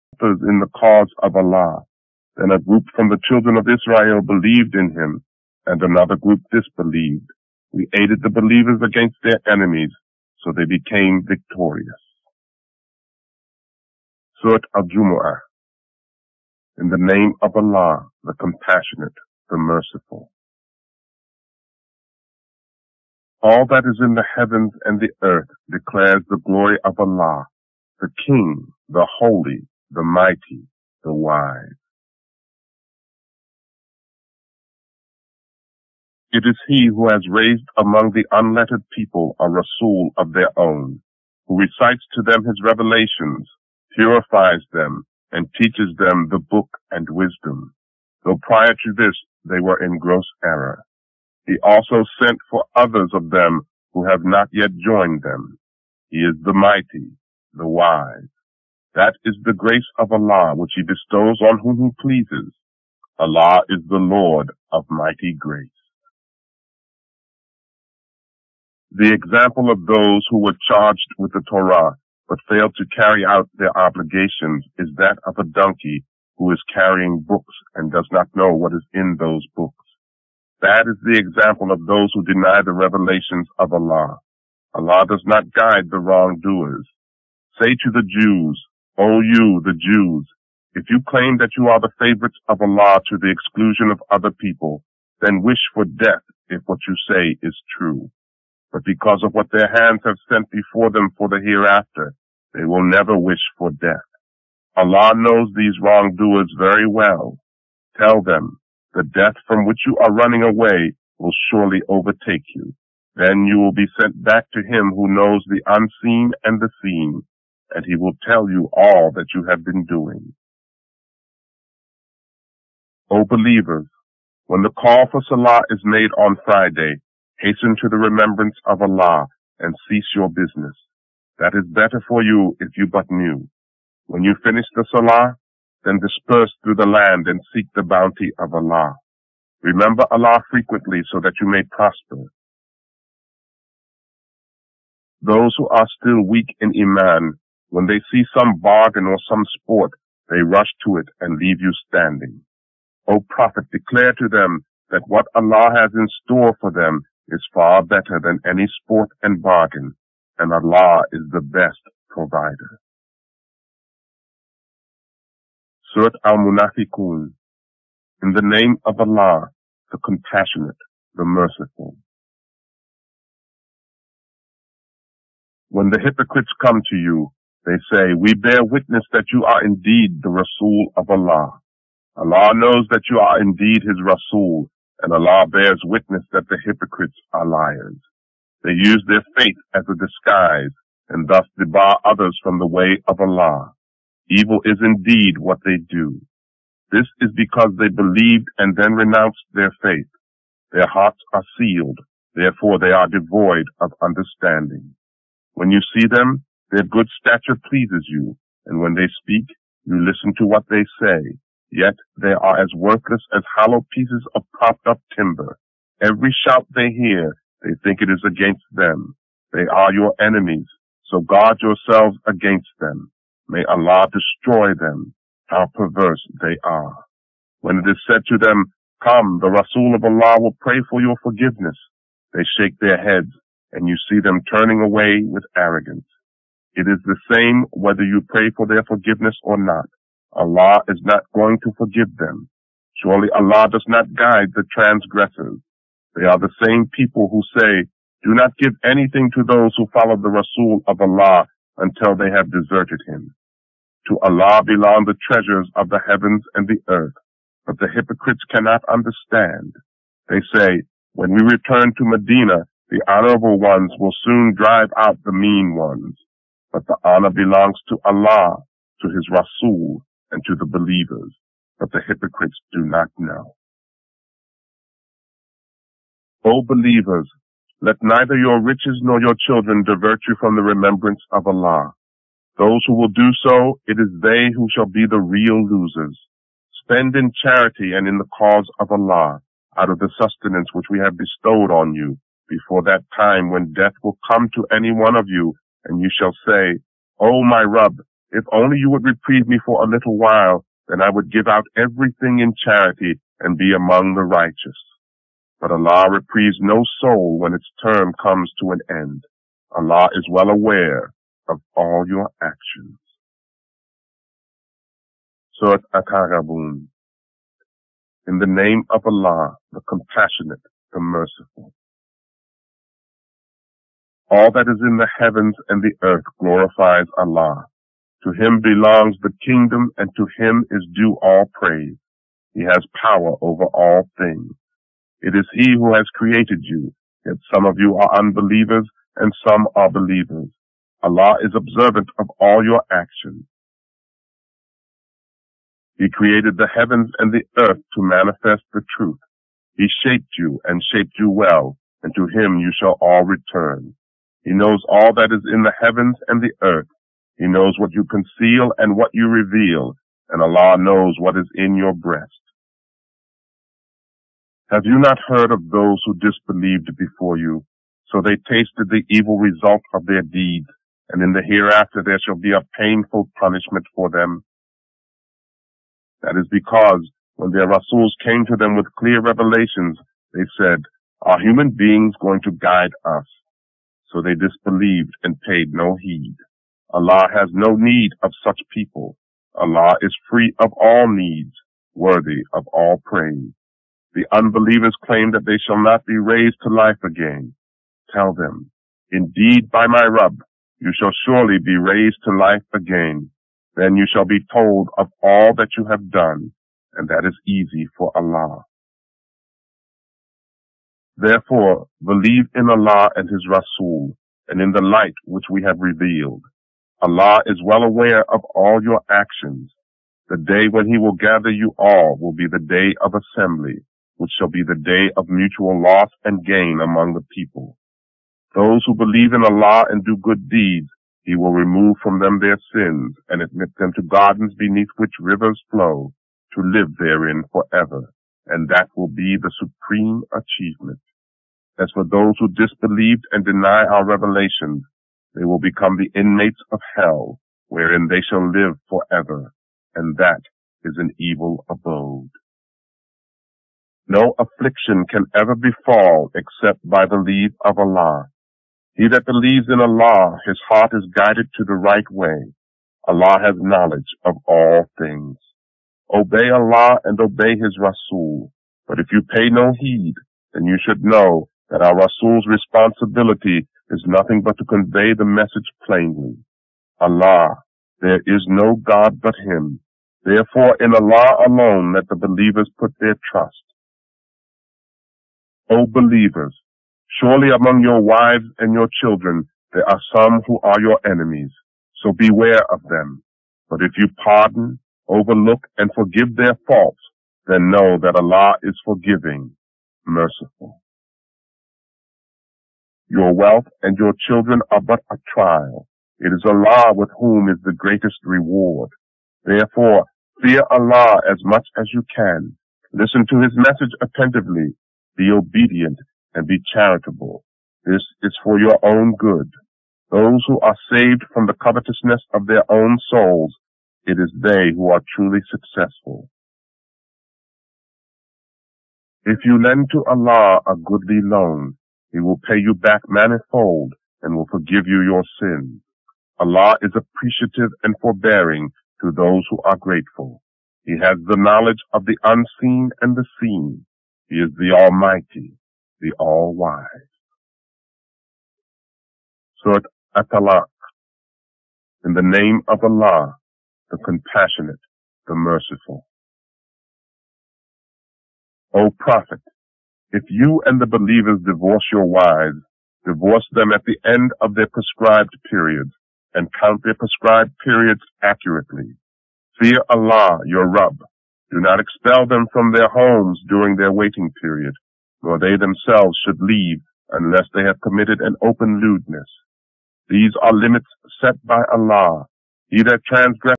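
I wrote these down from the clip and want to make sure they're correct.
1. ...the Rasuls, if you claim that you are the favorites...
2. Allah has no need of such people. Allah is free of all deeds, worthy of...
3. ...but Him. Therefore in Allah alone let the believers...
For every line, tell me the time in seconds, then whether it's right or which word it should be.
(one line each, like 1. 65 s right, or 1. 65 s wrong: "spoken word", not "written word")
1. 89 s wrong: "Jews", not "Rasuls"
2. 386 s wrong: "needs", not "deeds"
3. 479 s right.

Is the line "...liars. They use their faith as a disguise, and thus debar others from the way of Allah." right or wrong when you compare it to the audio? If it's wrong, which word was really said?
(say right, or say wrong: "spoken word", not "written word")
right.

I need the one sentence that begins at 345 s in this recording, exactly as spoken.
He created the heavens and the earth to manifest the truth.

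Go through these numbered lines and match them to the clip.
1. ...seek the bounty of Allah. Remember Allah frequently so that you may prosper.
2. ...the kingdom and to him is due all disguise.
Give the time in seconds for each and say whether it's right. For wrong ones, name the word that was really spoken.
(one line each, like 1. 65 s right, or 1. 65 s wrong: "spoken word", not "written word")
1. 137 s right
2. 329 s wrong: "praise", not "disguise".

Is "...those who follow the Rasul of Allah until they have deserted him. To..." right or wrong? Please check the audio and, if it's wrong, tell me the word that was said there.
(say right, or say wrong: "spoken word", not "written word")
right.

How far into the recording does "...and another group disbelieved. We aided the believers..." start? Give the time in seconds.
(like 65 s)
5 s.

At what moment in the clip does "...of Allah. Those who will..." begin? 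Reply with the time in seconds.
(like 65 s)
281 s.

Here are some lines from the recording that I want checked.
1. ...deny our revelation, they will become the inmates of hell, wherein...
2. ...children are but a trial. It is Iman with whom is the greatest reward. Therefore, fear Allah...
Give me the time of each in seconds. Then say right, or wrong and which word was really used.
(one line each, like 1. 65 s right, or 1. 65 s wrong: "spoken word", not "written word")
1. 443 s right
2. 504 s wrong: "Allah", not "Iman".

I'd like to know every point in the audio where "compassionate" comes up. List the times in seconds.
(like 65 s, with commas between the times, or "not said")
18 s, 169 s, 319 s, 553 s.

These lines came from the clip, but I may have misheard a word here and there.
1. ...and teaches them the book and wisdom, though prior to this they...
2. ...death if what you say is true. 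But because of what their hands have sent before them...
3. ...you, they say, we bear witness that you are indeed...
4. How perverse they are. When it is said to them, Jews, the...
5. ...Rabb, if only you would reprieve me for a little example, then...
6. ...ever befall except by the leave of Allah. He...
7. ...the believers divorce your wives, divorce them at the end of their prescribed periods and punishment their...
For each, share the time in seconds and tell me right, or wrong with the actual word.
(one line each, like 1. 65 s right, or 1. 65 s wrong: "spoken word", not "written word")
1. 45 s right
2. 95 s right
3. 176 s right
4. 225 s wrong: "Come", not "Jews"
5. 297 s wrong: "while", not "example"
6. 455 s right
7. 560 s wrong: "count", not "punishment".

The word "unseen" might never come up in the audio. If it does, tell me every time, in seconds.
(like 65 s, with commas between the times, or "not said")
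115 s, 542 s.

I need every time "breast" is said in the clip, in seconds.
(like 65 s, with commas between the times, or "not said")
361 s.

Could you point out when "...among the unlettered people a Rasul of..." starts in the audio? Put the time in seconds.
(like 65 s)
37 s.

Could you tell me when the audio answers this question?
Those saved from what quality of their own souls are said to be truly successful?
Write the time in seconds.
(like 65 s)
521 s.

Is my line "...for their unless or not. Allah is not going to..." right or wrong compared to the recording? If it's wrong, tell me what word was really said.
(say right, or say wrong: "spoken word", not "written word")
wrong: "forgiveness", not "unless".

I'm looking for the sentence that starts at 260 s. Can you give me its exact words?
They say, when we return to Medina, the honorable ones will soon drive out the mean ones.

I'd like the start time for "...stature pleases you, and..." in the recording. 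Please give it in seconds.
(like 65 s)
207 s.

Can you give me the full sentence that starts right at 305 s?
But Allah reprieves no soul when its term comes to an end.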